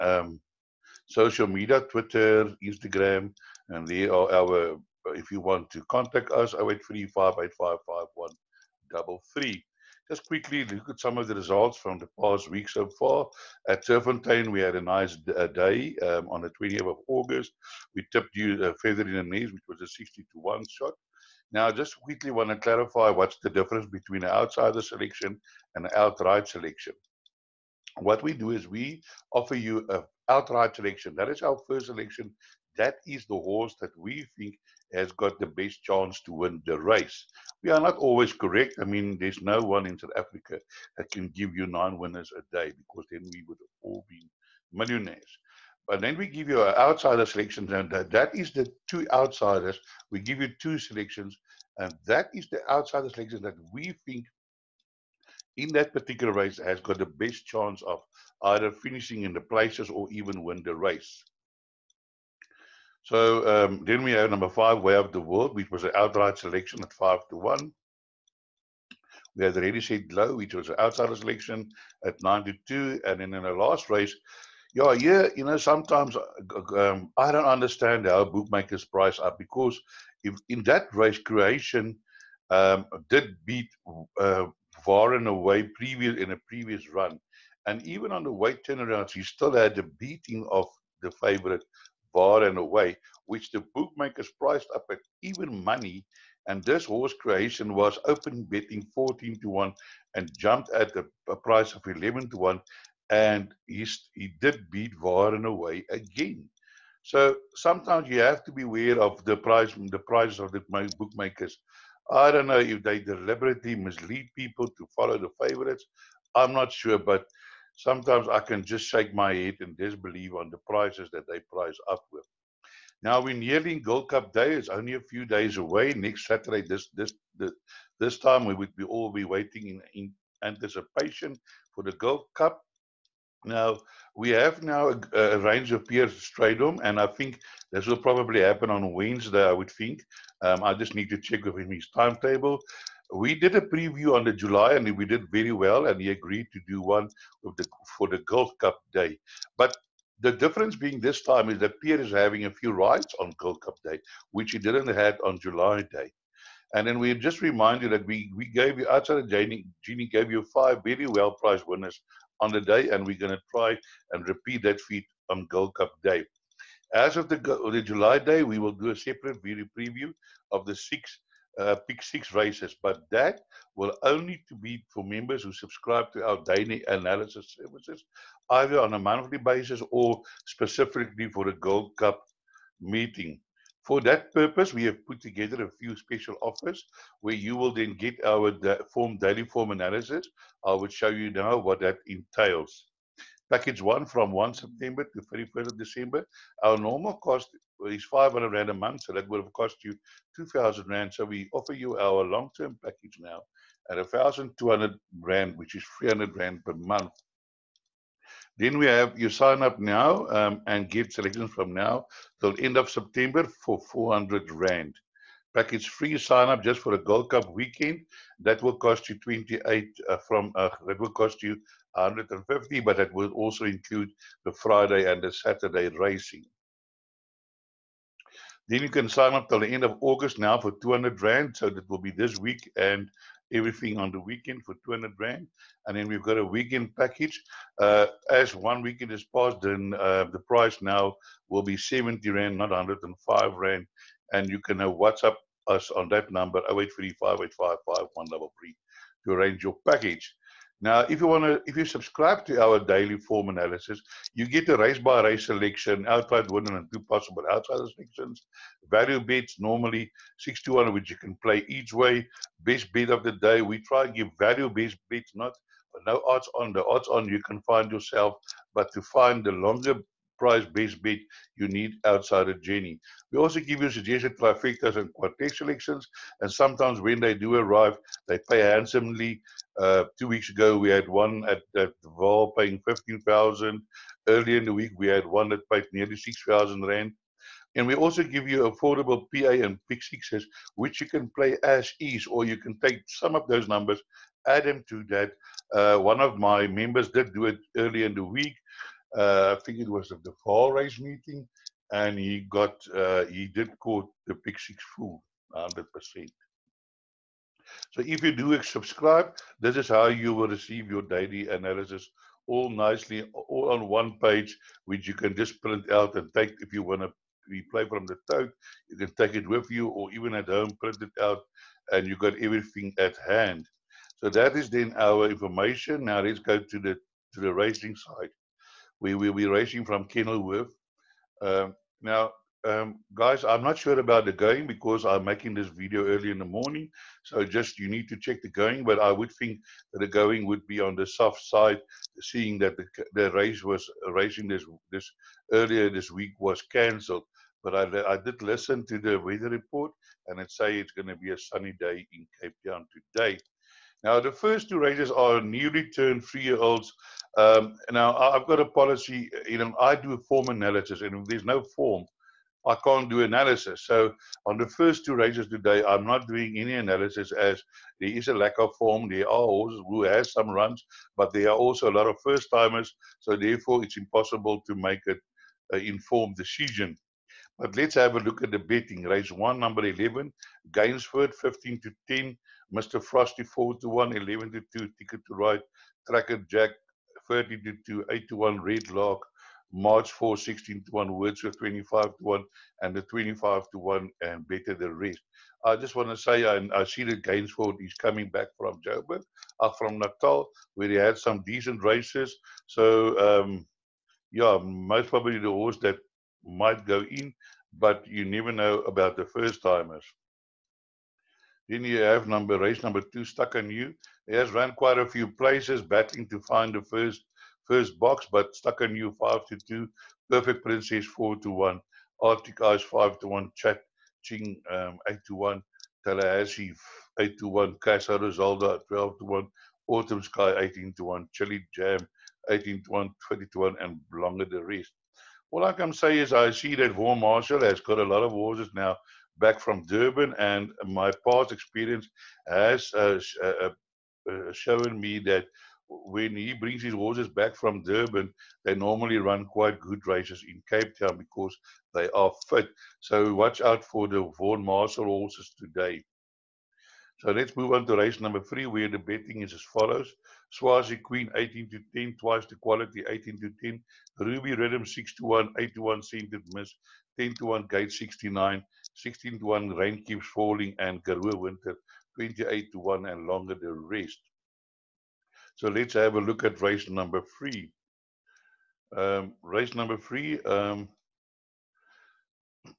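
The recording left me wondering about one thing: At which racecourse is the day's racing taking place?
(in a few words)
Kenilworth.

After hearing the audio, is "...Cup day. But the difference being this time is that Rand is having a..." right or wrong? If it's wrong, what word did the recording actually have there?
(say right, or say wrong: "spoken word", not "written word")
wrong: "Piere", not "Rand".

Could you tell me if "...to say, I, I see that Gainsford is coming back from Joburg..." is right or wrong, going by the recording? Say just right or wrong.
right.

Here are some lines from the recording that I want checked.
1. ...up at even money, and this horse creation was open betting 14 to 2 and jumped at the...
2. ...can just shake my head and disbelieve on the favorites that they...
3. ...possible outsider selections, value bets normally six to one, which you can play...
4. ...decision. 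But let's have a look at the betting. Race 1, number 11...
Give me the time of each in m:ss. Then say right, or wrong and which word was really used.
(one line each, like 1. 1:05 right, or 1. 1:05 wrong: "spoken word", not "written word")
1. 1:34 wrong: "1", not "2"
2. 1:58 wrong: "prices", not "favorites"
3. 4:16 right
4. 6:16 right.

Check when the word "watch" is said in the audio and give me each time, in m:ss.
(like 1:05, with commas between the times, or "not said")
7:33.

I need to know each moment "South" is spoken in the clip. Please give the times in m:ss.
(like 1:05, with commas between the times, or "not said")
0:39.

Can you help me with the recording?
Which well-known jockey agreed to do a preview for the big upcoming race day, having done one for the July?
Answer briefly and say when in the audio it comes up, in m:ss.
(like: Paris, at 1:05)
Piere Strydom, at 2:15.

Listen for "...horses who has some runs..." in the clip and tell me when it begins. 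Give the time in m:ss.
6:09.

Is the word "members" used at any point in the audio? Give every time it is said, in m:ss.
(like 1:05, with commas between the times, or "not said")
2:55, 4:56.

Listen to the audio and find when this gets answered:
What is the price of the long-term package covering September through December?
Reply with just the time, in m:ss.
3:23.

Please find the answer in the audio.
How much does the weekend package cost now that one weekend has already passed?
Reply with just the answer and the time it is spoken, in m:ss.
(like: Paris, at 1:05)
70 rand, at 4:01.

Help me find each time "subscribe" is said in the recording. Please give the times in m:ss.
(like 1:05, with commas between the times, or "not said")
2:55, 4:11, 5:08.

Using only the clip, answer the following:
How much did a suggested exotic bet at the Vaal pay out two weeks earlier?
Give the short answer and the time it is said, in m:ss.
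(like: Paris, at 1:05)
15,000, at 4:42.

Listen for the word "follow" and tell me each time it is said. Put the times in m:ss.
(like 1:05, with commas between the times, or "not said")
1:54, 7:39.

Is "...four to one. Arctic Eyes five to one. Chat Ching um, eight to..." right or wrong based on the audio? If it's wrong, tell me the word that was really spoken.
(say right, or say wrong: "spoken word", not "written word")
right.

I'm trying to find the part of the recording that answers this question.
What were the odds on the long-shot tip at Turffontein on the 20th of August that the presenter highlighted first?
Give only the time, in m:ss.
0:19.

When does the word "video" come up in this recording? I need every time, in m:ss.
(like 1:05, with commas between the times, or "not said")
2:49, 5:35.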